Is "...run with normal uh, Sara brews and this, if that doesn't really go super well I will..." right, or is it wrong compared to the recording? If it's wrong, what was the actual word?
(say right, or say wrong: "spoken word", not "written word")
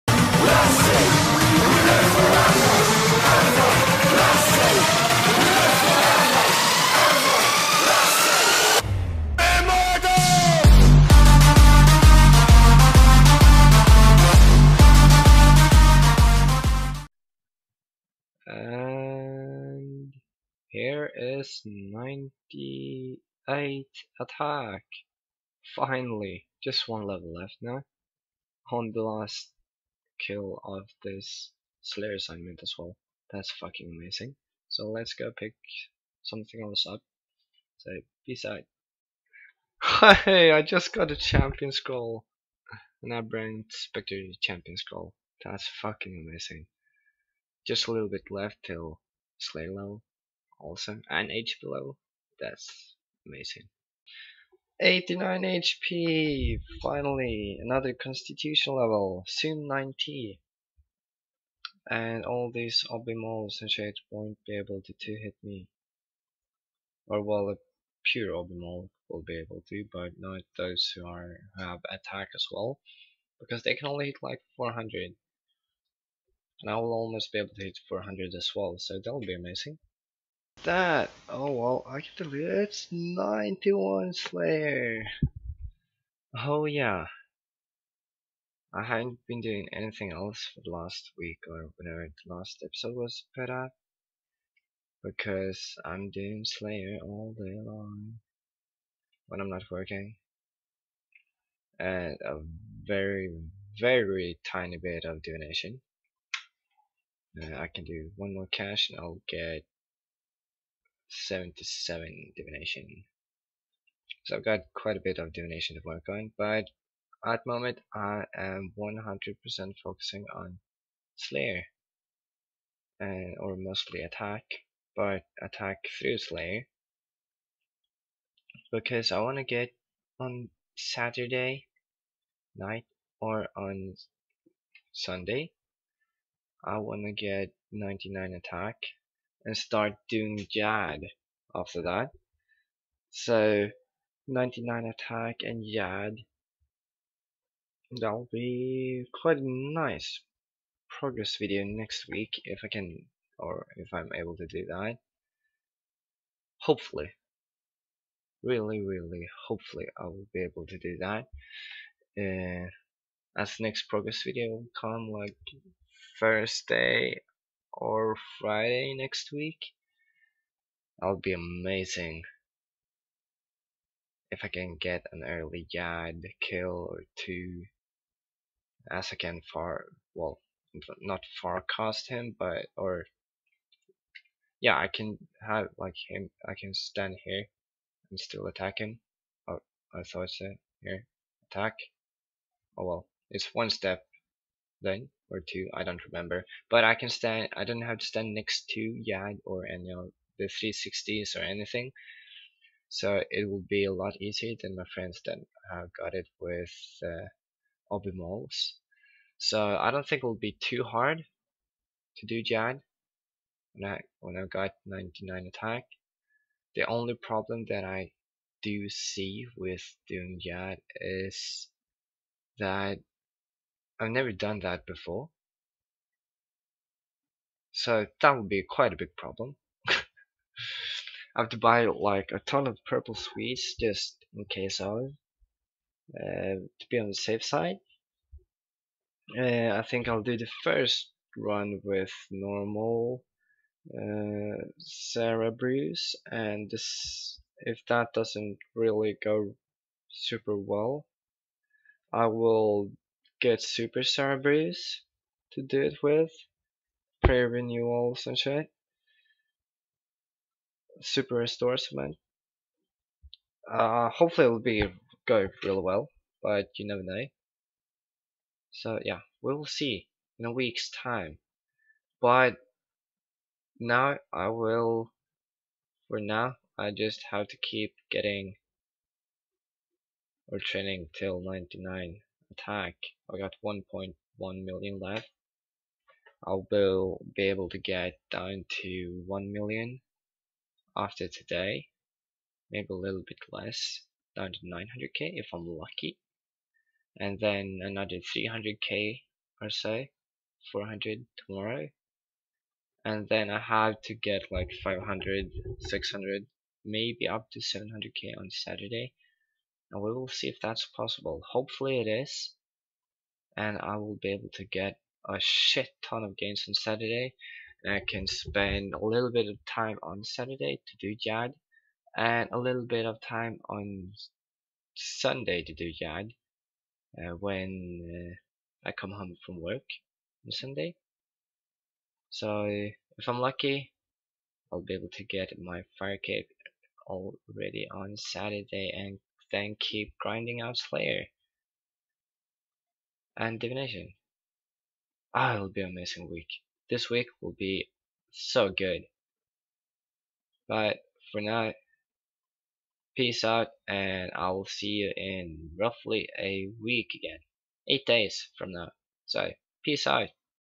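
right.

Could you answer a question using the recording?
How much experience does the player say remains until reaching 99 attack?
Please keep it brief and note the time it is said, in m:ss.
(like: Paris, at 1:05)
1.1 million, at 4:43.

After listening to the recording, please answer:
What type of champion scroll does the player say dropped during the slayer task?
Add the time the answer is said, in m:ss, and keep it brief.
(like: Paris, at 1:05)
Spectre, at 0:43.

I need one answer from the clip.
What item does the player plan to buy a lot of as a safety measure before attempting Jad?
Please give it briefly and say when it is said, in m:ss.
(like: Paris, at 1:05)
purple sweets, at 3:52.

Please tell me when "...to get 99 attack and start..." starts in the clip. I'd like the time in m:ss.
2:17.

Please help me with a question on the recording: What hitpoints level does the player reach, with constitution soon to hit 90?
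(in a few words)
89.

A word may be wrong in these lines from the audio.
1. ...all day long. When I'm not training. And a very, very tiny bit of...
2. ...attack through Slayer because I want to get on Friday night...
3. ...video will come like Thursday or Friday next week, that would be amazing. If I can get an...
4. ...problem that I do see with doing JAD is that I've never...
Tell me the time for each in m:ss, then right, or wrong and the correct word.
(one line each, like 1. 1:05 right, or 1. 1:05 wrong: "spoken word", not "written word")
1. 1:37 wrong: "working", not "training"
2. 2:05 wrong: "Saturday", not "Friday"
3. 2:44 right
4. 3:37 right.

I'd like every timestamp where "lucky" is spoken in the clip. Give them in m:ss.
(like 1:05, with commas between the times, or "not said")
4:55, 5:33.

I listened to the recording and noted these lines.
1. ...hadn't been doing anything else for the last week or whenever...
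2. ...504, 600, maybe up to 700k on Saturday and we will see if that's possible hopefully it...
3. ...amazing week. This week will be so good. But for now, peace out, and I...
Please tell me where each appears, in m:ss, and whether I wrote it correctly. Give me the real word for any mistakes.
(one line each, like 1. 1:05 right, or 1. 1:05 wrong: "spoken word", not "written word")
1. 1:28 right
2. 5:04 wrong: "500", not "504"
3. 5:45 right.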